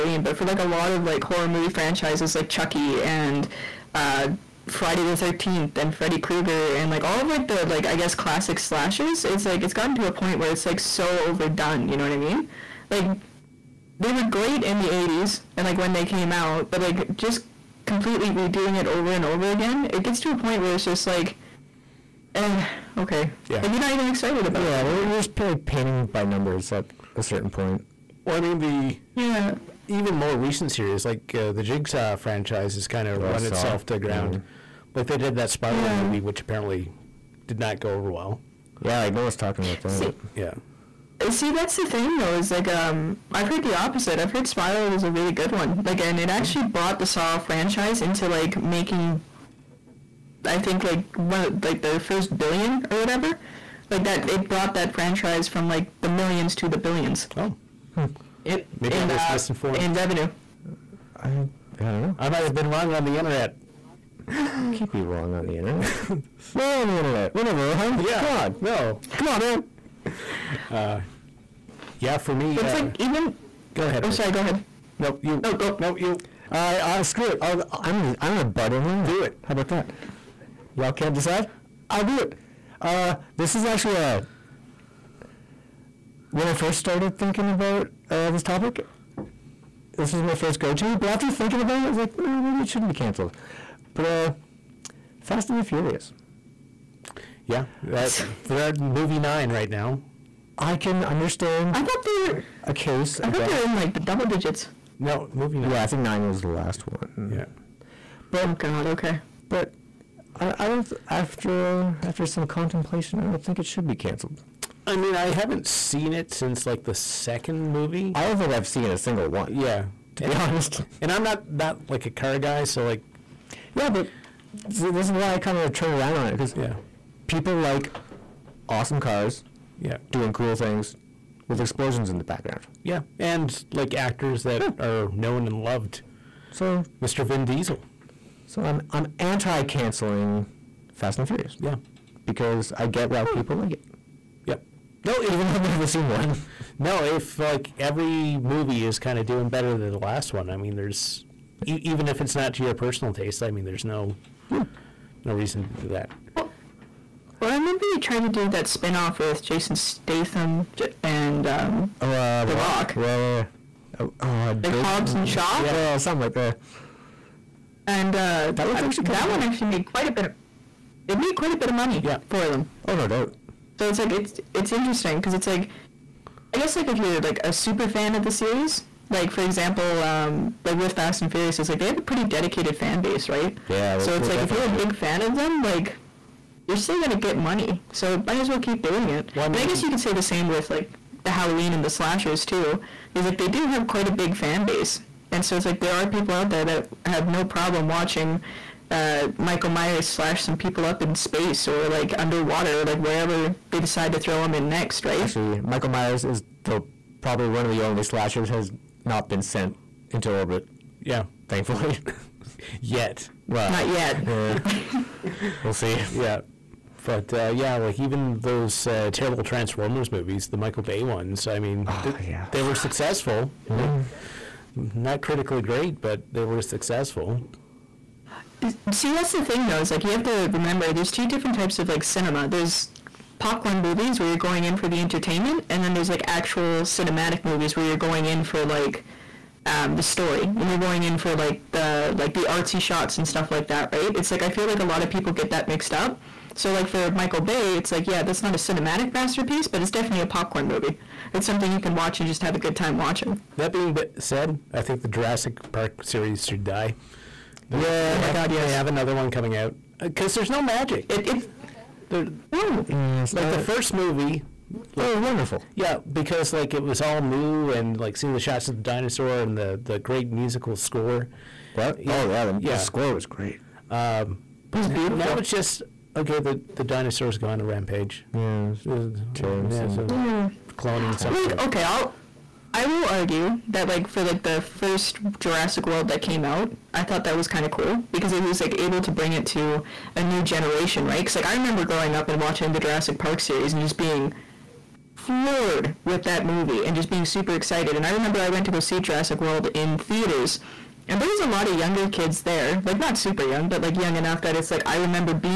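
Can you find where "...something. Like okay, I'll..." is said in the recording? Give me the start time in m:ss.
4:41.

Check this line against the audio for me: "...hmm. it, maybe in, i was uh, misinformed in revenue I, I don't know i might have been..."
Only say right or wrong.
right.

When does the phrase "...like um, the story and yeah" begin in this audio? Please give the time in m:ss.
3:58.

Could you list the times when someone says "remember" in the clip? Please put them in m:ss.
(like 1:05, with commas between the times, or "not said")
2:37, 3:50, 4:51, 4:58, 5:04.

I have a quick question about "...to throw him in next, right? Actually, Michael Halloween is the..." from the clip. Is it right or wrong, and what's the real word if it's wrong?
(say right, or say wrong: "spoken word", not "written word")
wrong: "Myers", not "Halloween".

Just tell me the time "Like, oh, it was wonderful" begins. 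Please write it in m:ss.
4:24.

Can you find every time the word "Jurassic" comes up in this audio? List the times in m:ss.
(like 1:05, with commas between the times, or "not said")
4:15, 4:45, 4:52, 4:59.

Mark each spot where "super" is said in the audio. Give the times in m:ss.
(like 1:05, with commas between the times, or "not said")
2:57, 4:57, 5:03.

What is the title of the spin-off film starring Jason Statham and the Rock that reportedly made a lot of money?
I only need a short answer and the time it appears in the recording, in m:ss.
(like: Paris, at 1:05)
Hobbs and Shaw, at 2:44.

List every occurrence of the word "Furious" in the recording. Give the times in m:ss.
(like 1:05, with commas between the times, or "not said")
1:35, 2:21, 3:01.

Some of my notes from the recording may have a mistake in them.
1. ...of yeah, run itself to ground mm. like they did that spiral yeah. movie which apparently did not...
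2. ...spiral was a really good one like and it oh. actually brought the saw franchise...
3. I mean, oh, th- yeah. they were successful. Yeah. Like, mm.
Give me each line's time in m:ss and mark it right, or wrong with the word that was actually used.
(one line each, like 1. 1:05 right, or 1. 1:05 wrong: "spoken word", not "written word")
1. 0:33 right
2. 0:44 right
3. 3:41 right.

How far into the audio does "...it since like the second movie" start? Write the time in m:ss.
1:56.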